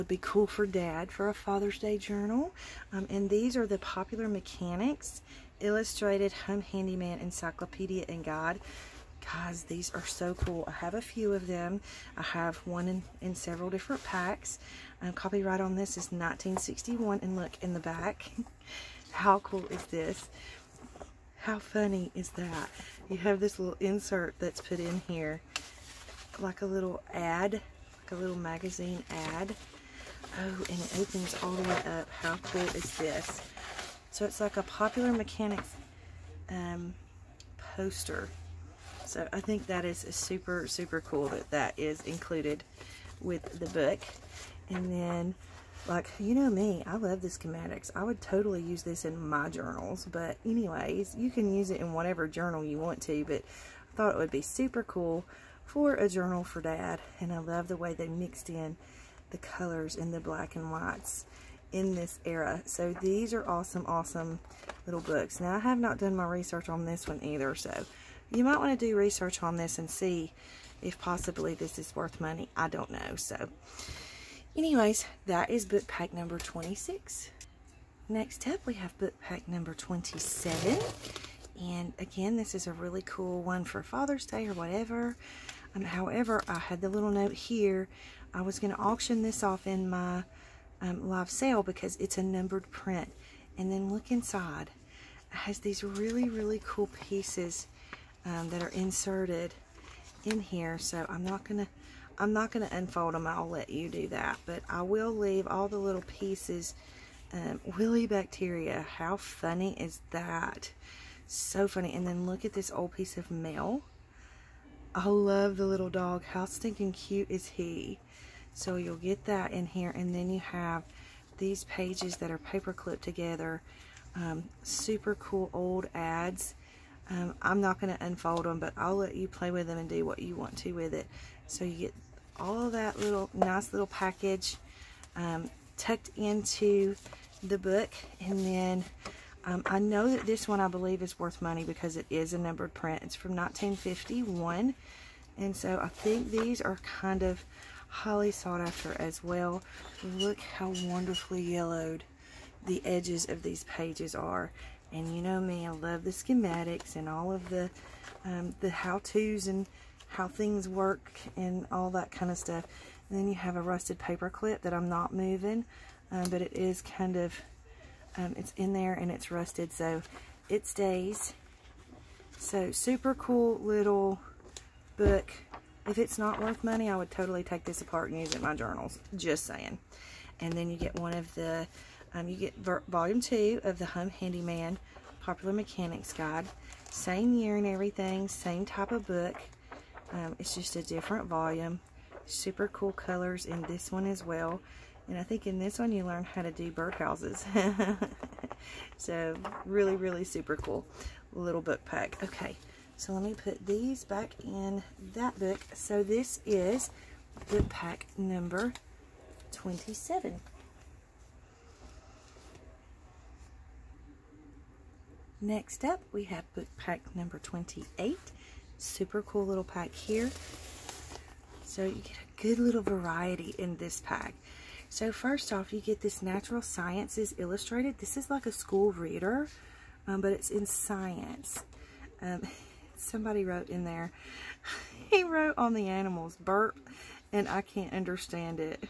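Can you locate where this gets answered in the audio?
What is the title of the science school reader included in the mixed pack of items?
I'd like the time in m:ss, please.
3:46.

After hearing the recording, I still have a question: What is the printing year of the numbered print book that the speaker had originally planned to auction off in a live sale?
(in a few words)
1951.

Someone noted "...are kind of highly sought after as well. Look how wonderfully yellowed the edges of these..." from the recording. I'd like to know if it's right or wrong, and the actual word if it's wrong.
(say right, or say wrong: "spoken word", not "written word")
right.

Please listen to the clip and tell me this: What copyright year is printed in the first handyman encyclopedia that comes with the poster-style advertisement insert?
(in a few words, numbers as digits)
1961.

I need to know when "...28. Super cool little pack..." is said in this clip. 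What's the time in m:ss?
3:37.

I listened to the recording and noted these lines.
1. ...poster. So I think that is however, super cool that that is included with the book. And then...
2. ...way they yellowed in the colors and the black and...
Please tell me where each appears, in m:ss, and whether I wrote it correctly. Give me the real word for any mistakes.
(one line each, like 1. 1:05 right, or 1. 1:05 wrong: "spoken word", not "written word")
1. 0:37 wrong: "super", not "however"
2. 0:57 wrong: "mixed", not "yellowed".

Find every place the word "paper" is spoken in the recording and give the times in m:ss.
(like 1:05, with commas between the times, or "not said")
2:02, 2:43.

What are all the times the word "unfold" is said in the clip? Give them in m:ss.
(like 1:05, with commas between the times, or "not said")
1:42, 2:08.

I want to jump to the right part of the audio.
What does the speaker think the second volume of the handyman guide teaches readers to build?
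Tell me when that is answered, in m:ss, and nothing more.
3:16.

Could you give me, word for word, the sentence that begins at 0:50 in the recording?
But anyways, you can use it in whatever journal you want to.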